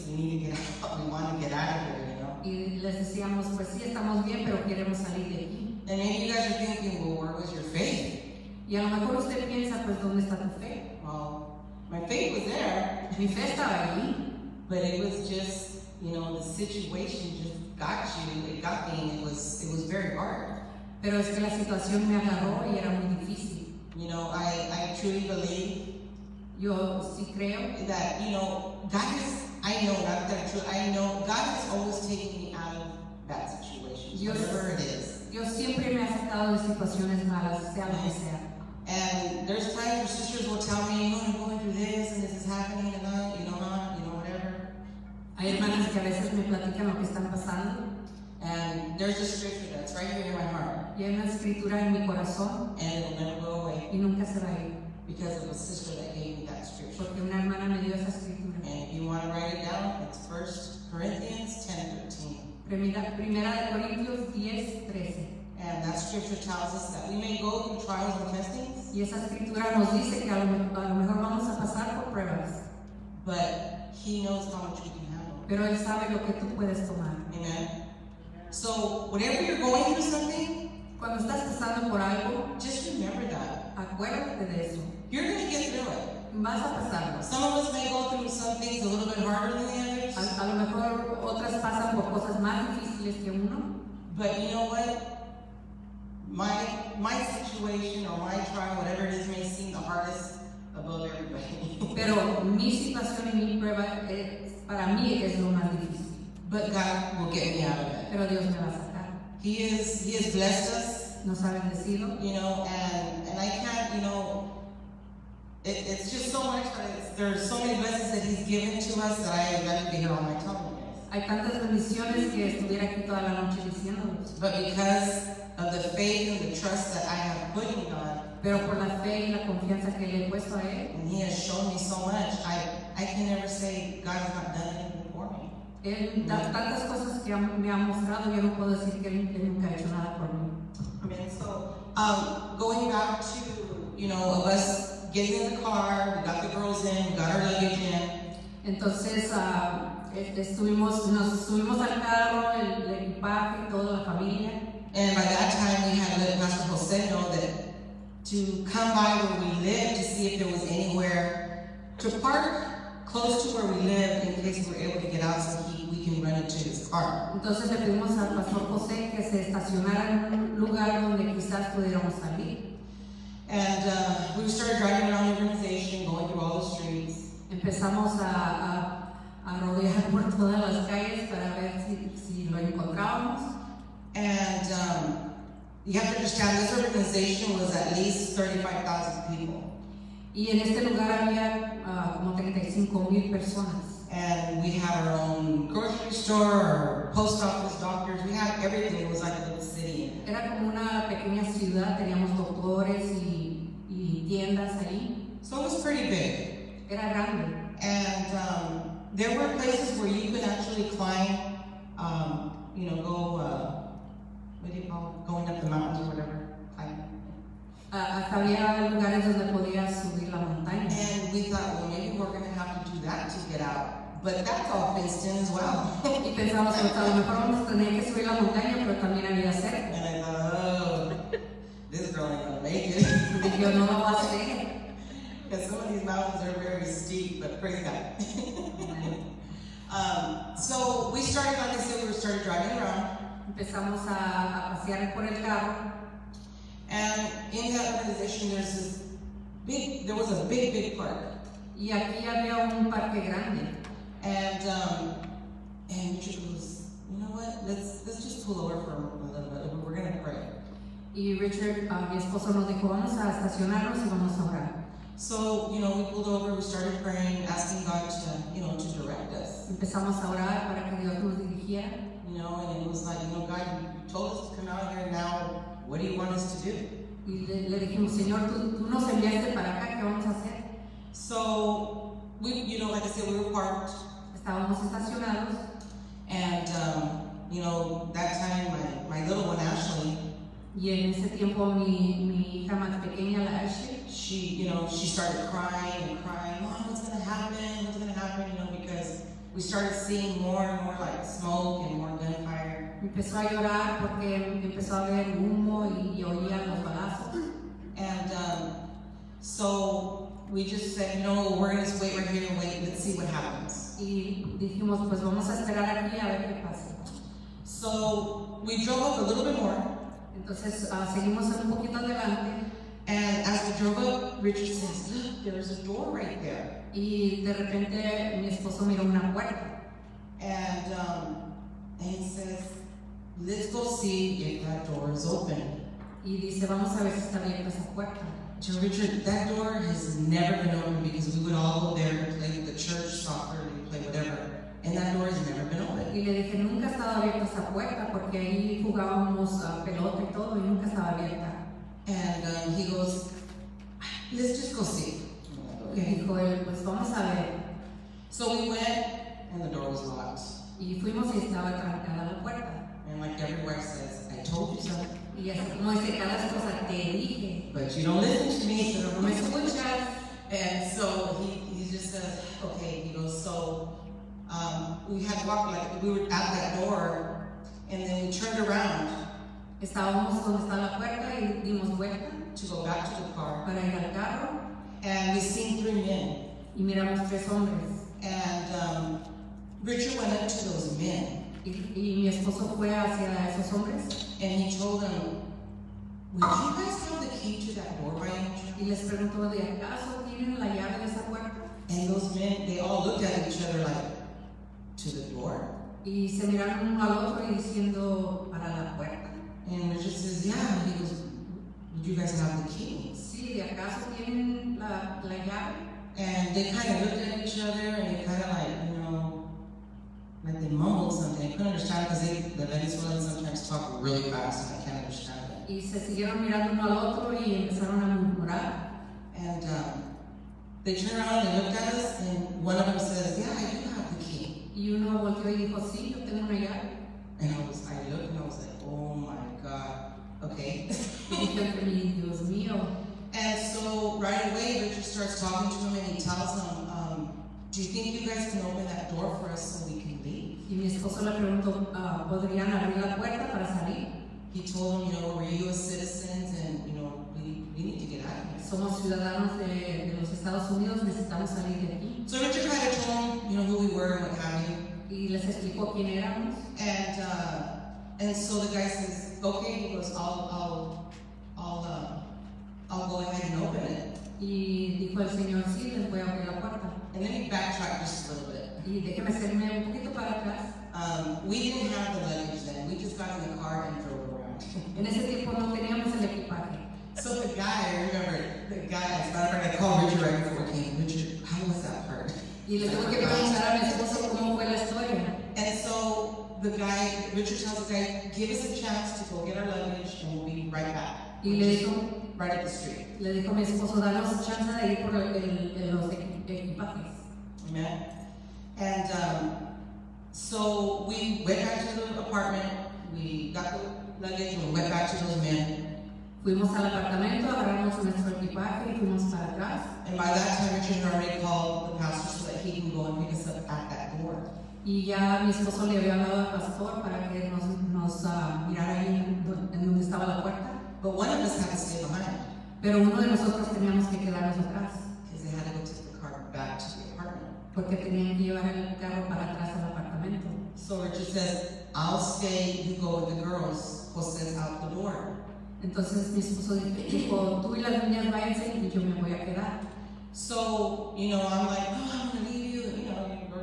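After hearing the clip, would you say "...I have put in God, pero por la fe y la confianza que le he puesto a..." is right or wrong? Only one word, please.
right.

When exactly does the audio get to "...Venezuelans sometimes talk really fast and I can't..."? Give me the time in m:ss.
7:02.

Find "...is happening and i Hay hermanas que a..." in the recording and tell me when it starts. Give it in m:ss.
0:42.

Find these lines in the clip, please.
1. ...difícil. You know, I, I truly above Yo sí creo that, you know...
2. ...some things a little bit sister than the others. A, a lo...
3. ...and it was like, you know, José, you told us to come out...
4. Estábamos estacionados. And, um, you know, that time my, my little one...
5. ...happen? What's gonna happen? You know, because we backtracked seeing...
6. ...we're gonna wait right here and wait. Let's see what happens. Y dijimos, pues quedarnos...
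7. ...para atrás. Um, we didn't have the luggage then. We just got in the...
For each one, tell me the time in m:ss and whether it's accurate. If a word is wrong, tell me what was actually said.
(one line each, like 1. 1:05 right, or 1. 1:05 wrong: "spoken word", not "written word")
1. 0:23 wrong: "believe", not "above"
2. 1:28 wrong: "harder", not "sister"
3. 4:32 wrong: "God", not "José"
4. 4:44 right
5. 4:57 wrong: "started", not "backtracked"
6. 5:11 wrong: "vamos", not "quedarnos"
7. 8:00 right.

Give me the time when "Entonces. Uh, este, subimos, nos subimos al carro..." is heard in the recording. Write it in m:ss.
2:28.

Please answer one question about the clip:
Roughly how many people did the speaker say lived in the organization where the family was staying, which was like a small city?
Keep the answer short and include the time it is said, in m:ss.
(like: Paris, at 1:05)
35,000, at 3:08.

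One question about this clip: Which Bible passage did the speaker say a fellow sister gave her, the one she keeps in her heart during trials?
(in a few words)
1 Corinthians 10:13.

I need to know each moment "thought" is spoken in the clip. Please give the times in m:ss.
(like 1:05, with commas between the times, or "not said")
3:41, 3:46.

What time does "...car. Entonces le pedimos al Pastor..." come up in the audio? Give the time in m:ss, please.
2:46.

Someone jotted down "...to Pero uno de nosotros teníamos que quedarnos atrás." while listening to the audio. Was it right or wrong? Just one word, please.
right.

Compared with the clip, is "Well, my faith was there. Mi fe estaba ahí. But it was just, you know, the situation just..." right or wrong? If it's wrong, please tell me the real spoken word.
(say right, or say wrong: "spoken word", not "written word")
right.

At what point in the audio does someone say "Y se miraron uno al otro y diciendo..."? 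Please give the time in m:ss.
6:46.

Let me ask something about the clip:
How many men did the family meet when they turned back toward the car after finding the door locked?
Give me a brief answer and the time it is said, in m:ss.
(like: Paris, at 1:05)
3, at 6:27.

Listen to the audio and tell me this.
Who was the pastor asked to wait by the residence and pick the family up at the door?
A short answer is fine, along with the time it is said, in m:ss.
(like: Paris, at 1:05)
Pastor Jose, at 2:36.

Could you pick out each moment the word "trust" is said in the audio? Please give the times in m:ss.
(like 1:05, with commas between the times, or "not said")
2:06.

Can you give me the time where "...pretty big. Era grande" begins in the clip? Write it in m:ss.
3:25.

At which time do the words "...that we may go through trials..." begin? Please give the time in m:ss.
1:06.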